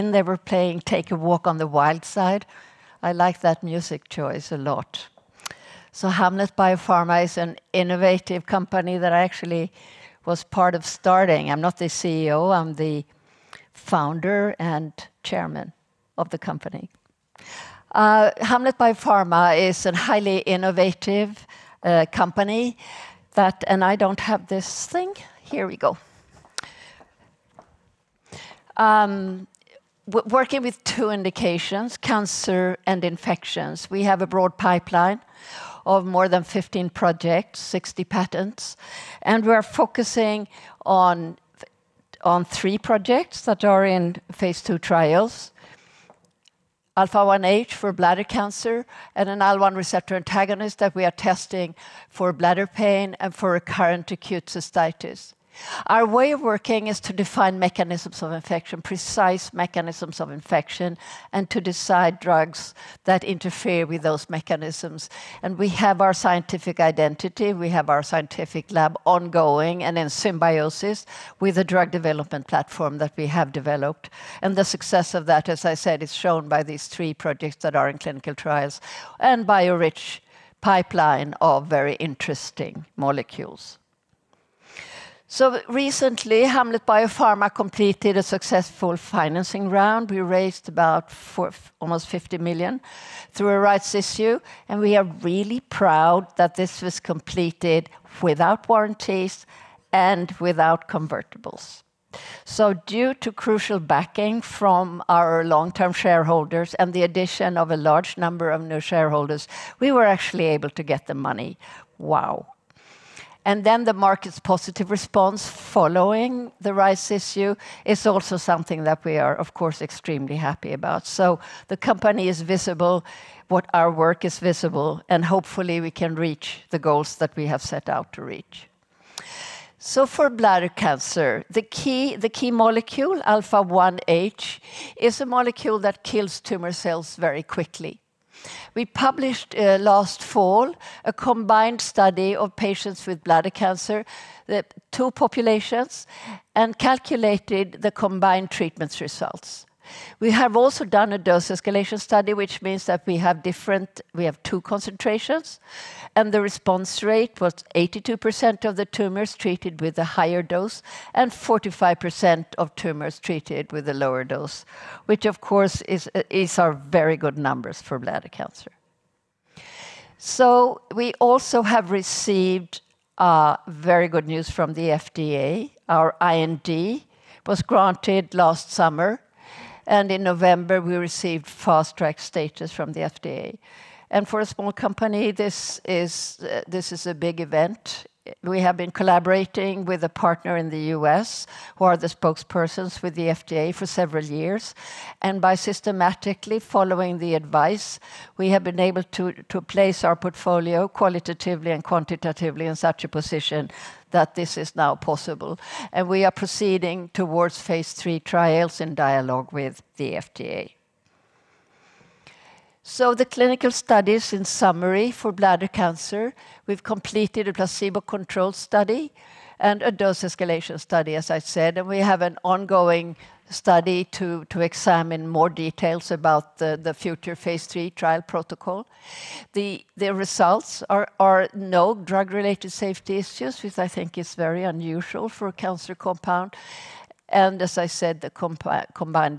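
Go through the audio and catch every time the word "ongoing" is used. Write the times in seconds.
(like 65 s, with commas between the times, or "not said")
69 s, 222 s.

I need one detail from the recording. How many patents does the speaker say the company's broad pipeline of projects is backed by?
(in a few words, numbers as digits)
60.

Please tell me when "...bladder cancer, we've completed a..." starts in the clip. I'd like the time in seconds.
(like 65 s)
215 s.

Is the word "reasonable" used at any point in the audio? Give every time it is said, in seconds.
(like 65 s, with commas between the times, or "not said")
not said.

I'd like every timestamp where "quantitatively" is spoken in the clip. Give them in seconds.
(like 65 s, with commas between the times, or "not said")
201 s.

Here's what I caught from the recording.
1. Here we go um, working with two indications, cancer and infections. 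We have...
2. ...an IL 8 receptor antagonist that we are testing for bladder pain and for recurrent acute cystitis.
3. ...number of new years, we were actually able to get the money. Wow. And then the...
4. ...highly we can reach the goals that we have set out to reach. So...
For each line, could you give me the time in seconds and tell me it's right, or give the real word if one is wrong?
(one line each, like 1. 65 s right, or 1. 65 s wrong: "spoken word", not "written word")
1. 25 s right
2. 49 s wrong: "1", not "8"
3. 108 s wrong: "shareholders", not "years"
4. 125 s wrong: "hopefully", not "highly".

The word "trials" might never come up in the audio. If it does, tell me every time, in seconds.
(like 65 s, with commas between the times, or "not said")
44 s, 78 s, 208 s, 227 s.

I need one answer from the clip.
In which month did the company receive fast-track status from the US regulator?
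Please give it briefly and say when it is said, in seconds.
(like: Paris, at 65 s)
November, at 180 s.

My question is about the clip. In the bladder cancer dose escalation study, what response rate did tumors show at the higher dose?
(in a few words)
82%.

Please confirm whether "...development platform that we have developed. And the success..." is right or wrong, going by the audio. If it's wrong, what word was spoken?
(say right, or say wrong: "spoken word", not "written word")
right.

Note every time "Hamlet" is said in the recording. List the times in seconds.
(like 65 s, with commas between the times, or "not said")
6 s, 18 s, 86 s.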